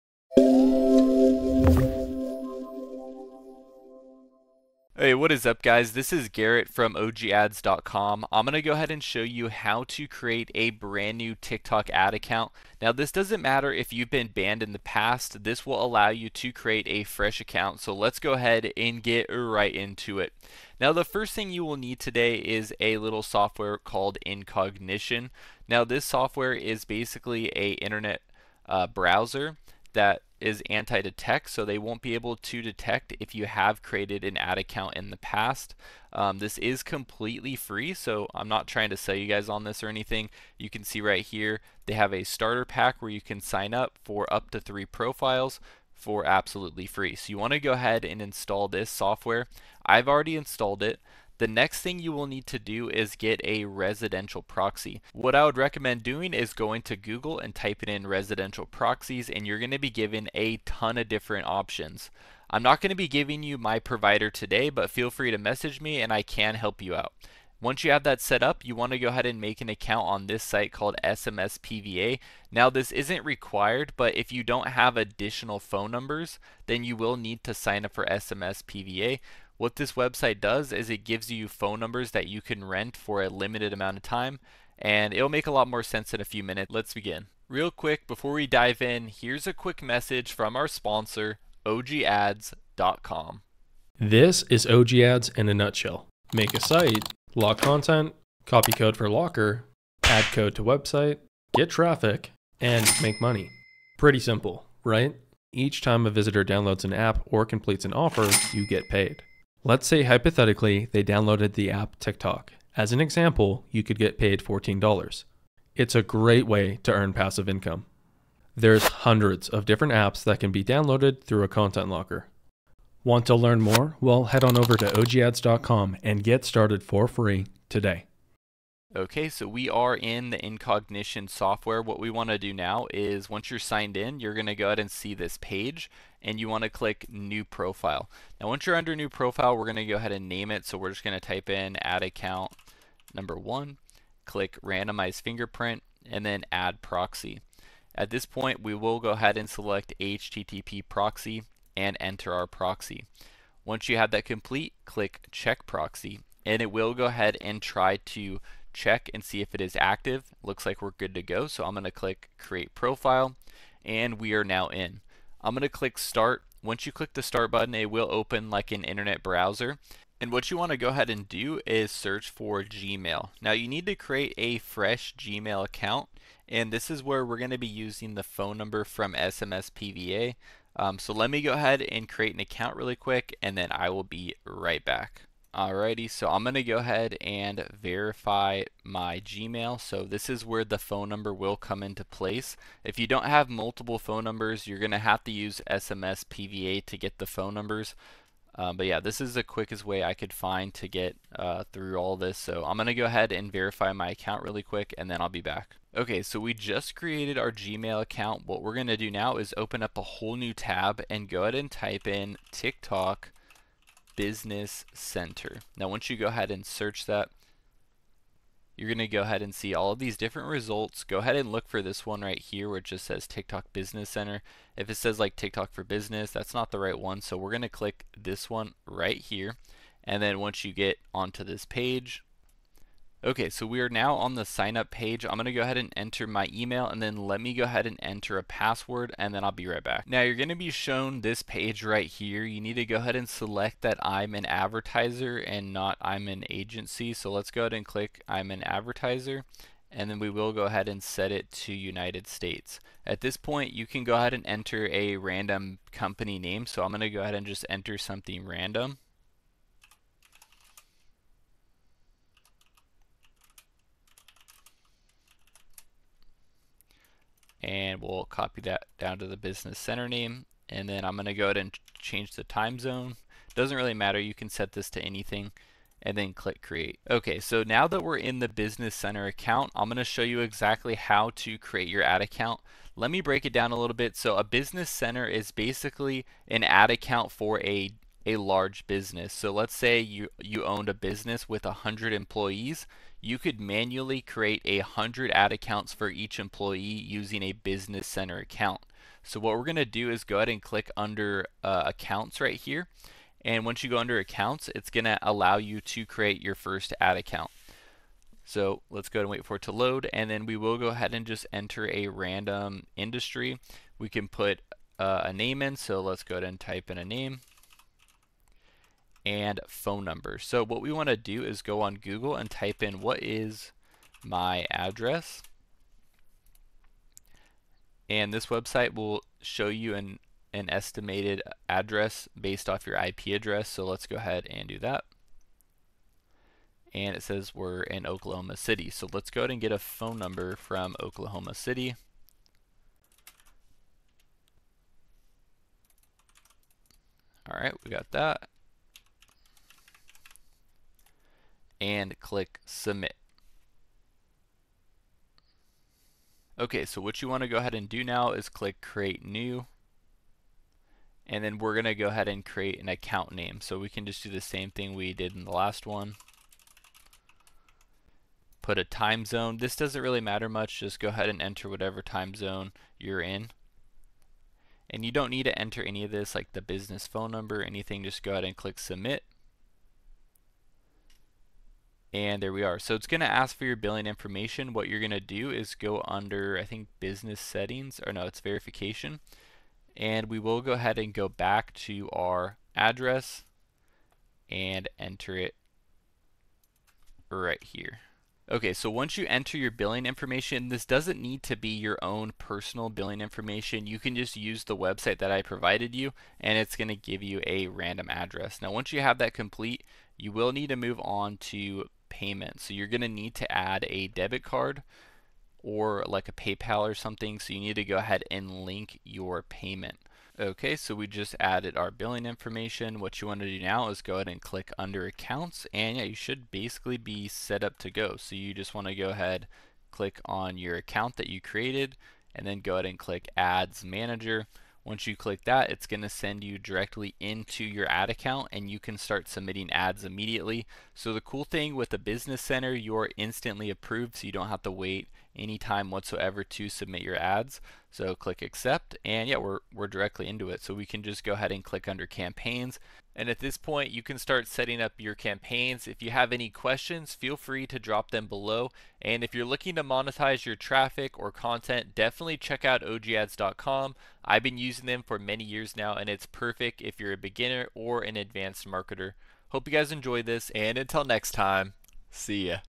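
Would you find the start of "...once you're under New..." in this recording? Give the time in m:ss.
2:18.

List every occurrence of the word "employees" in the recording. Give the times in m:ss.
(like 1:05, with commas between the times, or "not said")
4:52, 4:56.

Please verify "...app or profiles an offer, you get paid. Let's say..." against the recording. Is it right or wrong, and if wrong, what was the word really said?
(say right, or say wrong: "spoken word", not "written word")
wrong: "completes", not "profiles".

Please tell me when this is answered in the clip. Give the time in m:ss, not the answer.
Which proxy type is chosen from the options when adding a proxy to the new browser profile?
2:30.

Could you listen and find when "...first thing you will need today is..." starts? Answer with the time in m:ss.
0:21.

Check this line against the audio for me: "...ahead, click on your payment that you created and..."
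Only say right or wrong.
wrong.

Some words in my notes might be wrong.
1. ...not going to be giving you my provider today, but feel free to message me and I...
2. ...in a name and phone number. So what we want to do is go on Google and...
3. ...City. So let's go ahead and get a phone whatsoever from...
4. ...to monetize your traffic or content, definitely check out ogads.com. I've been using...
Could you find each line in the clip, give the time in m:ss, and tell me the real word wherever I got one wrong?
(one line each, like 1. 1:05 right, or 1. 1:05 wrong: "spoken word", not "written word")
1. 1:02 right
2. 5:16 right
3. 5:38 wrong: "number", not "whatsoever"
4. 7:39 right.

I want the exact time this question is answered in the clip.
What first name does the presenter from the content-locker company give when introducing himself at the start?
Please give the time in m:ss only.
0:06.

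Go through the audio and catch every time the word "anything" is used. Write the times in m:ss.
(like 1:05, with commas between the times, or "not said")
0:39, 4:35, 6:17.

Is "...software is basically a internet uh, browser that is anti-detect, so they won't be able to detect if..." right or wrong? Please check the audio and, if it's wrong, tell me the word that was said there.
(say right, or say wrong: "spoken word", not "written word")
right.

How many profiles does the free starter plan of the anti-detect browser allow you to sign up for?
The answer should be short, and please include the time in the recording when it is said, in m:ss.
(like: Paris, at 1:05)
3, at 0:44.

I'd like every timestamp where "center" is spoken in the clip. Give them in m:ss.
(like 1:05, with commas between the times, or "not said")
3:34, 3:44, 4:29, 4:38, 4:44, 4:58, 7:22.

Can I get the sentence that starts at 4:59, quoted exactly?
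So what we're going to do is go ahead and click under uh, accounts right here.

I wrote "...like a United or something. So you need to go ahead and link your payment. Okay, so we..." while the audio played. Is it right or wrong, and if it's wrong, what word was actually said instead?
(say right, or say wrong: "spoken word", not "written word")
wrong: "PayPal", not "United".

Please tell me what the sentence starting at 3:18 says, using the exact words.
Um, but yeah, this is the quickest way I could find to get uh, through all this.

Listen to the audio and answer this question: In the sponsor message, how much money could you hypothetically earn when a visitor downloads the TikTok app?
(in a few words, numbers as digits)
$14.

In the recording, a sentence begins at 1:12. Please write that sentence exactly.
Now, this isn't required, but if you don't have additional phone numbers, then you will need to sign up for SMS PVA.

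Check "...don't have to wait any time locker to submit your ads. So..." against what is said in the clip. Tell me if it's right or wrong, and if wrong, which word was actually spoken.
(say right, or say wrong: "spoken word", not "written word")
wrong: "whatsoever", not "locker".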